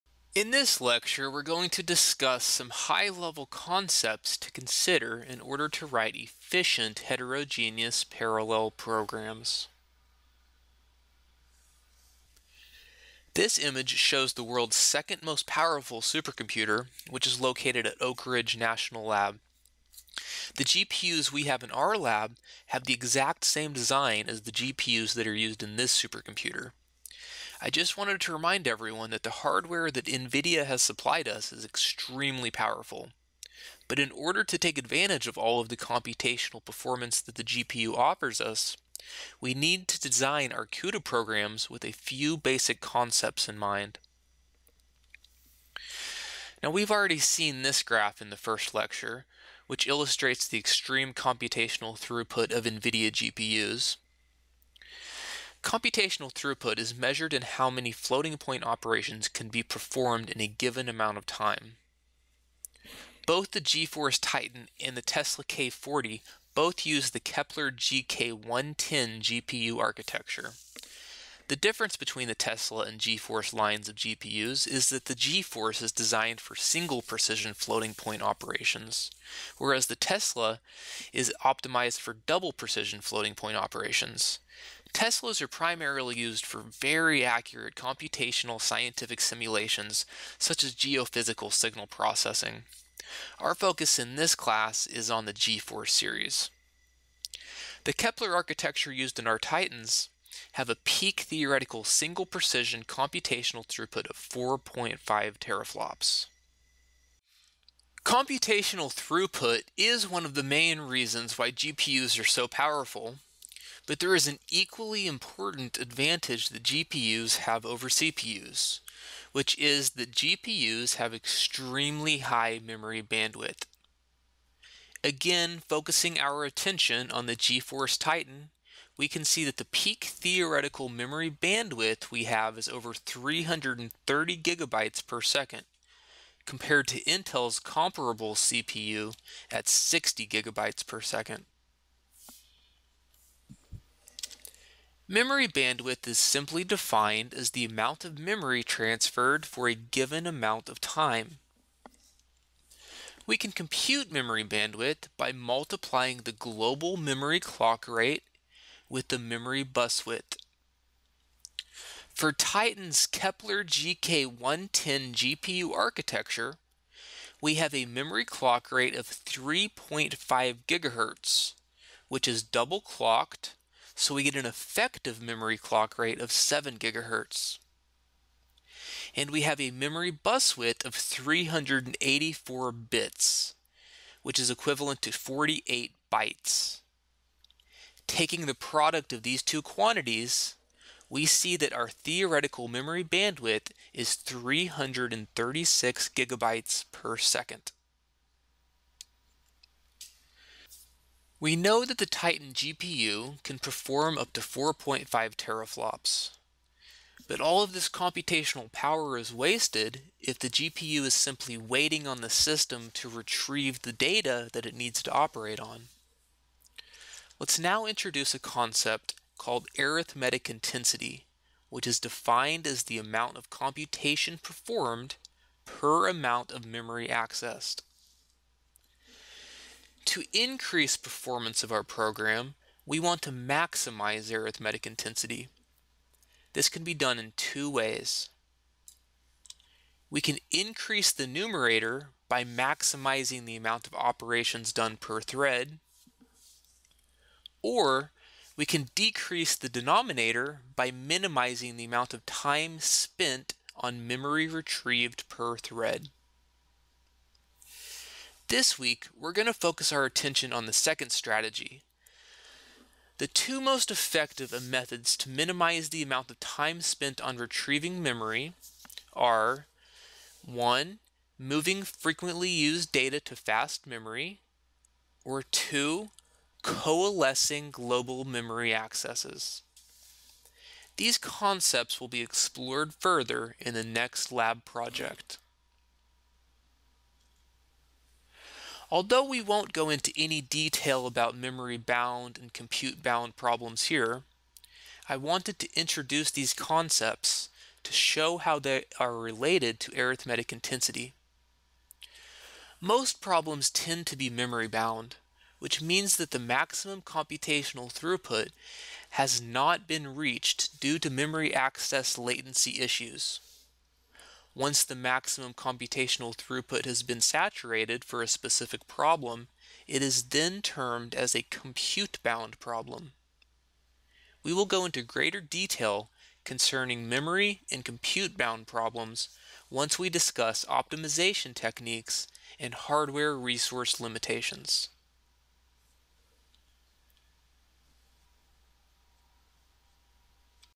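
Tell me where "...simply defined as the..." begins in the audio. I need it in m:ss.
2:26.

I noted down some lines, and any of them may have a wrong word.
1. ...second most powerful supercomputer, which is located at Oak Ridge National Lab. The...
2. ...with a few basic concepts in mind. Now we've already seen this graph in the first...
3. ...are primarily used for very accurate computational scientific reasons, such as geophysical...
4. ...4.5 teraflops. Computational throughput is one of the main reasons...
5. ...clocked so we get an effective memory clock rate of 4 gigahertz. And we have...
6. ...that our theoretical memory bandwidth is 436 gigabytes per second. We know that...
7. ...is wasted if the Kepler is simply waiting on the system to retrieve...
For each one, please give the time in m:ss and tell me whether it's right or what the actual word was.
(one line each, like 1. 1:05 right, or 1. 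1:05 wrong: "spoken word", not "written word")
1. 0:14 right
2. 0:41 right
3. 1:25 wrong: "simulations", not "reasons"
4. 1:44 right
5. 2:52 wrong: "7", not "4"
6. 3:11 wrong: "336", not "436"
7. 3:29 wrong: "GPU", not "Kepler".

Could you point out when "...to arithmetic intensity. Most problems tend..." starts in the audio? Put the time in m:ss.
4:59.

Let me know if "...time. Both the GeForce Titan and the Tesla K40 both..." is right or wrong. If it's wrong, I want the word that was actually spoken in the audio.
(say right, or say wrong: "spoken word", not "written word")
right.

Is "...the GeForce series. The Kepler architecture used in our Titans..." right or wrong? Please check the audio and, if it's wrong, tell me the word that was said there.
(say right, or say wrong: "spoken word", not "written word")
right.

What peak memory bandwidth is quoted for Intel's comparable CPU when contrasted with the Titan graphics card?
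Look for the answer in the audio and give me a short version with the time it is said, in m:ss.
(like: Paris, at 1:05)
60 gigabytes per second, at 2:19.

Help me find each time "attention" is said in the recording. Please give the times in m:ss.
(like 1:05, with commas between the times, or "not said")
2:06, 4:20.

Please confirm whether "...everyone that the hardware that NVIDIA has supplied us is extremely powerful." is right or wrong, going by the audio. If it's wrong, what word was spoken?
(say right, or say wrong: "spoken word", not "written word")
right.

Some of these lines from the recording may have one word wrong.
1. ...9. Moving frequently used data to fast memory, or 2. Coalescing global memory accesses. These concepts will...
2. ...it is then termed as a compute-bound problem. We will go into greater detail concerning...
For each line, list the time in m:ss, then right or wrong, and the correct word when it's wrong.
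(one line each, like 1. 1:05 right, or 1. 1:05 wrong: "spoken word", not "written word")
1. 4:30 wrong: "1", not "9"
2. 5:19 right.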